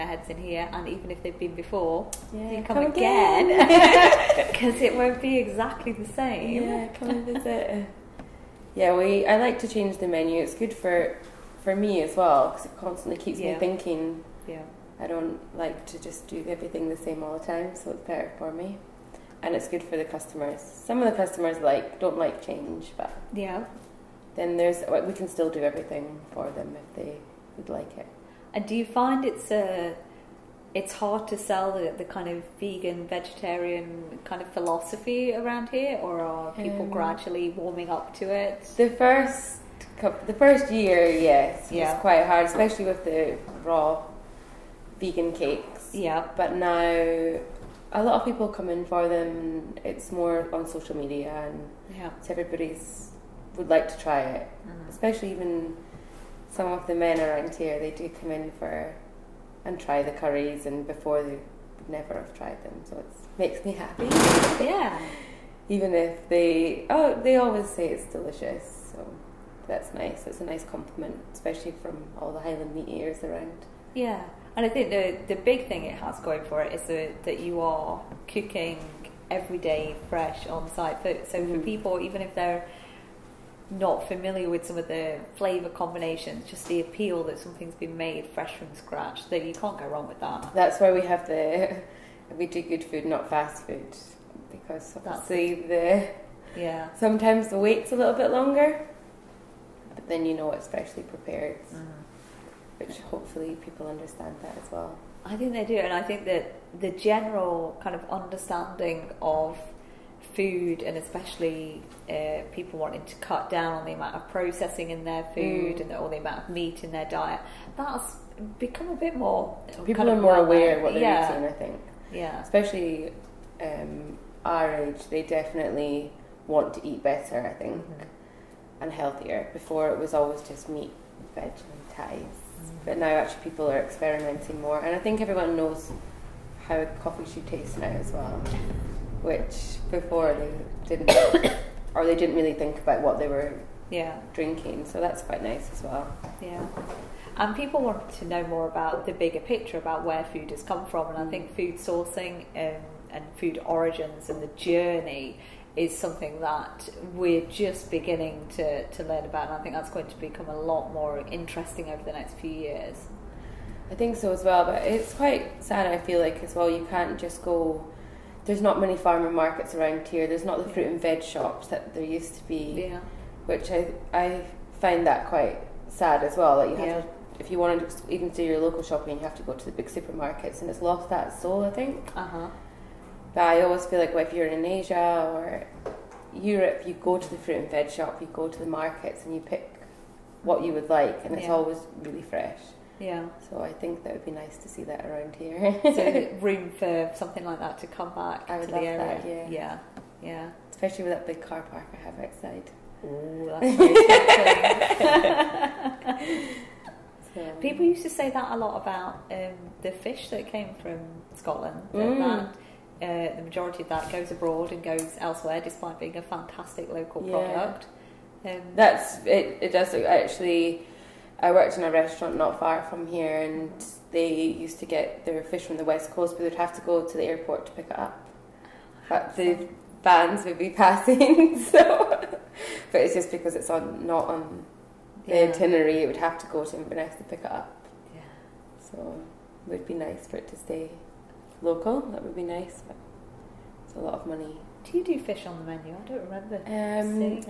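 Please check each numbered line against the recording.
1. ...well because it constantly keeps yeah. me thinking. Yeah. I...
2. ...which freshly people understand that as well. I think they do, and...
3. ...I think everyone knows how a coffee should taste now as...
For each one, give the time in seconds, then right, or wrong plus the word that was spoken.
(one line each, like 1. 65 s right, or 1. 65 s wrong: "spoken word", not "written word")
1. 12 s right
2. 102 s wrong: "hopefully", not "freshly"
3. 134 s right.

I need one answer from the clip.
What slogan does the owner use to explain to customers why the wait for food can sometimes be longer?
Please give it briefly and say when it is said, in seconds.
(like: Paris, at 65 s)
Good food, not fast food, at 92 s.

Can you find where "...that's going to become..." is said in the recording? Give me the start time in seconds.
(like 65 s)
159 s.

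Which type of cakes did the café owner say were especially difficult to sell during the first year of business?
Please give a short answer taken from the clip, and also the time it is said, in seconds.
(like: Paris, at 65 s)
Raw vegan cakes, at 43 s.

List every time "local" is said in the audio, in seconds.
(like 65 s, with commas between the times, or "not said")
178 s, 216 s, 241 s.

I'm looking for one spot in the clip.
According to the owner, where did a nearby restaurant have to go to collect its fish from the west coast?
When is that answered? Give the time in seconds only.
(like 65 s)
227 s.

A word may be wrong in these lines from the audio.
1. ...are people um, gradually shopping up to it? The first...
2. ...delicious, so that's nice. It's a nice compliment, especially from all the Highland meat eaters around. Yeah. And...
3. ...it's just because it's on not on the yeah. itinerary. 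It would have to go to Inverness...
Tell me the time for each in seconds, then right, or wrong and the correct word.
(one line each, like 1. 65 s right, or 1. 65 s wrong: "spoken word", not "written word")
1. 36 s wrong: "warming", not "shopping"
2. 68 s right
3. 233 s right.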